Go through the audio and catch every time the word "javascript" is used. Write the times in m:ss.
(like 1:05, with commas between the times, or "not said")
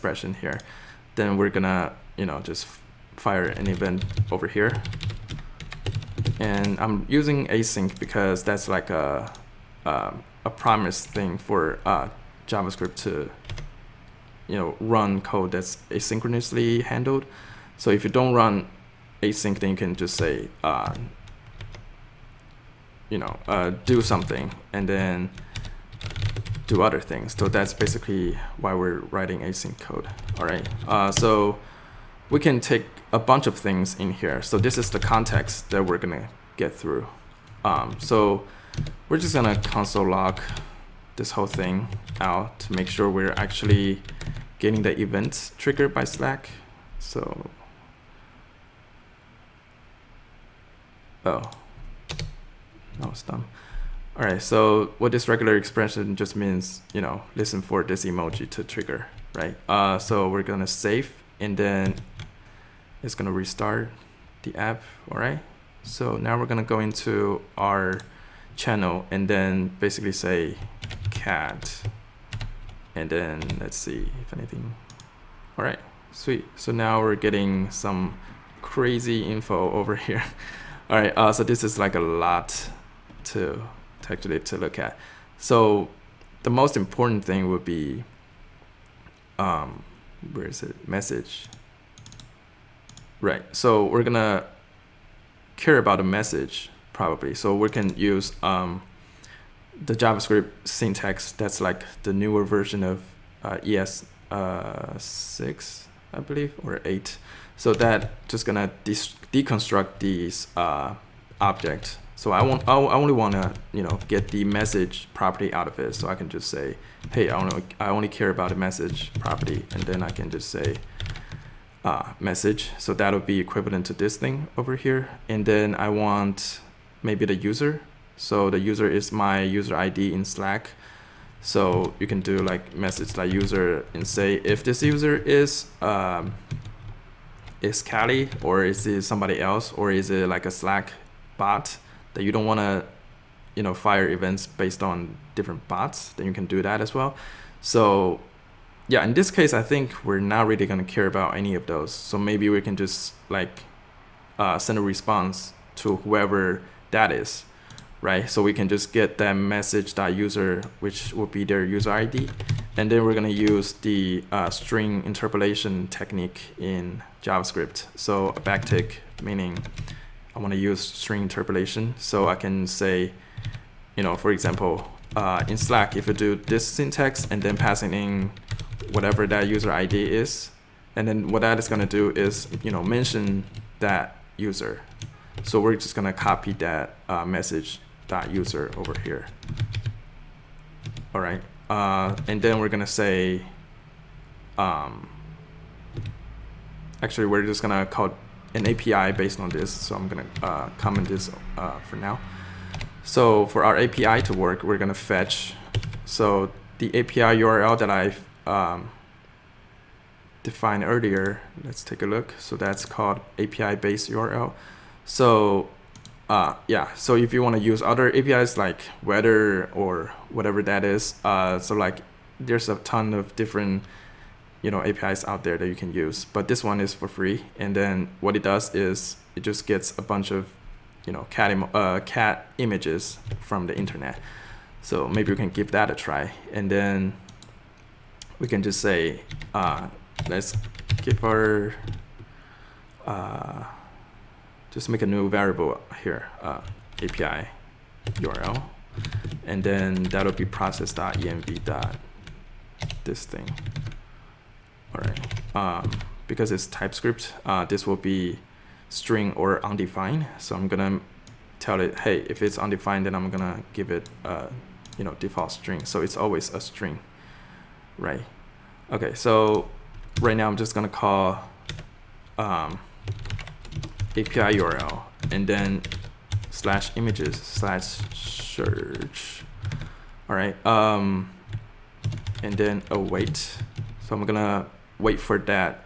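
0:12, 1:39, 2:47.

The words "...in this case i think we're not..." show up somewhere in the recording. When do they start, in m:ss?
2:29.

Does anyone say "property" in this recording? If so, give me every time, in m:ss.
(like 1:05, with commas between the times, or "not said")
1:55, 1:59.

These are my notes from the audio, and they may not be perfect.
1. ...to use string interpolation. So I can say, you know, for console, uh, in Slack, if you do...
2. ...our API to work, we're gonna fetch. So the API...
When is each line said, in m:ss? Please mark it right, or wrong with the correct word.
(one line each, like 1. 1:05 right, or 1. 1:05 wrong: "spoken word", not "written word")
1. 2:50 wrong: "example", not "console"
2. 3:23 right.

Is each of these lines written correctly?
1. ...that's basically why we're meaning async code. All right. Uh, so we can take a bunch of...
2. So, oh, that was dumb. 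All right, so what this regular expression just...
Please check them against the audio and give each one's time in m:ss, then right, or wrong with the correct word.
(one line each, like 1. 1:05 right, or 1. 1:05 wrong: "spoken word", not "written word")
1. 0:27 wrong: "writing", not "meaning"
2. 0:46 right.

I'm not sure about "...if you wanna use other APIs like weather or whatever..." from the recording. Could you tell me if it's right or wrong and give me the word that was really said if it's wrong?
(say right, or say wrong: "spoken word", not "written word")
right.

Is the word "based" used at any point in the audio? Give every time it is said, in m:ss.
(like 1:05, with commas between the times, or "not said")
2:24, 3:19, 3:33.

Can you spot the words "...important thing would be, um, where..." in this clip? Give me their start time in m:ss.
1:26.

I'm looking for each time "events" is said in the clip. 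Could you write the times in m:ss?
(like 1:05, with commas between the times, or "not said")
0:03, 0:44, 2:24.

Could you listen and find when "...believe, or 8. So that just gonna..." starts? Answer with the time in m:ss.
1:46.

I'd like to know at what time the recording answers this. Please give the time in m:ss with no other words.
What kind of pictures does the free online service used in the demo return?
3:51.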